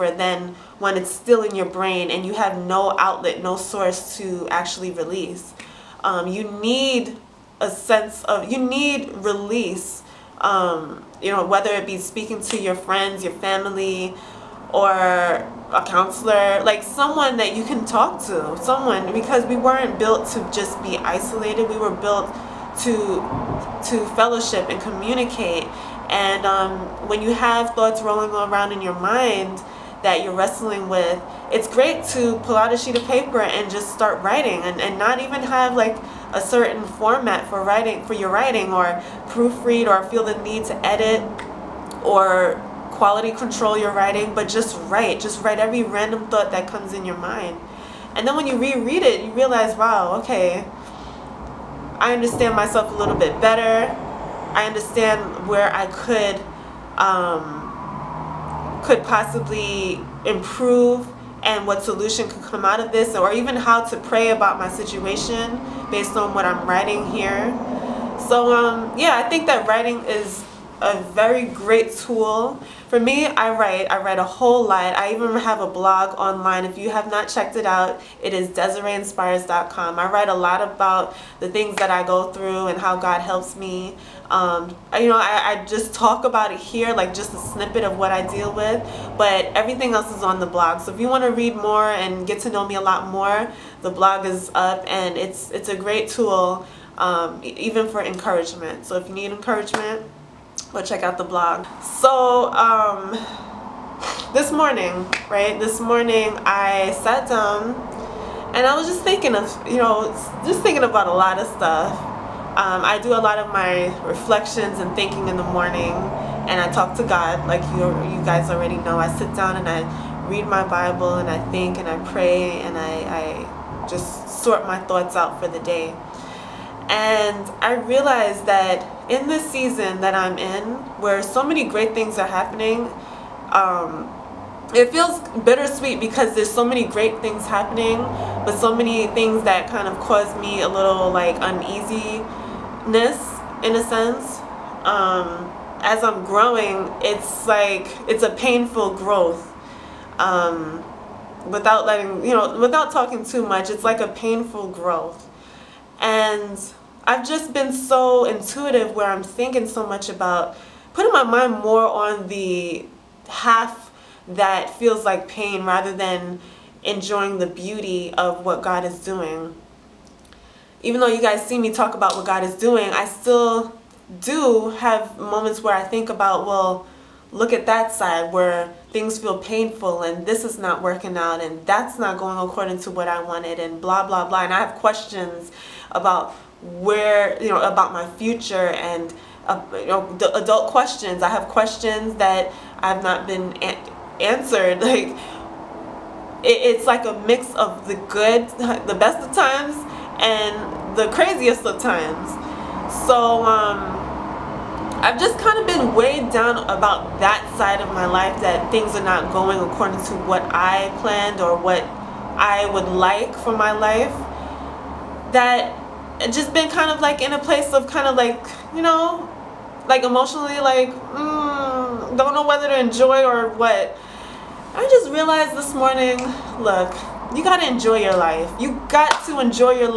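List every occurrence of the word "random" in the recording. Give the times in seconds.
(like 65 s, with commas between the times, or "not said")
45 s.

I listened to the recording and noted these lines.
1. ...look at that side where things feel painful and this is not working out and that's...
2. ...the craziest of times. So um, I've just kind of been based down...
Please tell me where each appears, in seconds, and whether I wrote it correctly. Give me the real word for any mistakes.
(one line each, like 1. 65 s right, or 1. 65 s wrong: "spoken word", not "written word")
1. 177 s right
2. 200 s wrong: "weighed", not "based".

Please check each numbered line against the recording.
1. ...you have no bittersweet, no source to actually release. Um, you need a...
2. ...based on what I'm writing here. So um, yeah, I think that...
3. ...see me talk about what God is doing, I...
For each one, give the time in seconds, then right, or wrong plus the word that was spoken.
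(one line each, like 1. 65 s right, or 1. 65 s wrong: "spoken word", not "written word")
1. 2 s wrong: "outlet", not "bittersweet"
2. 65 s right
3. 171 s right.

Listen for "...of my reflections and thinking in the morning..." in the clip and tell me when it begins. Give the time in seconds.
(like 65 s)
113 s.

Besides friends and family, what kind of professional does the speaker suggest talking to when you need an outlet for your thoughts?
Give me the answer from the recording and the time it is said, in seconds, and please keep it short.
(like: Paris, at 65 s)
A counselor, at 14 s.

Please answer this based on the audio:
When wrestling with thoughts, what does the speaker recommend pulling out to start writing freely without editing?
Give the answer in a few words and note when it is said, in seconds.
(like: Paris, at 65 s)
A sheet of paper, at 32 s.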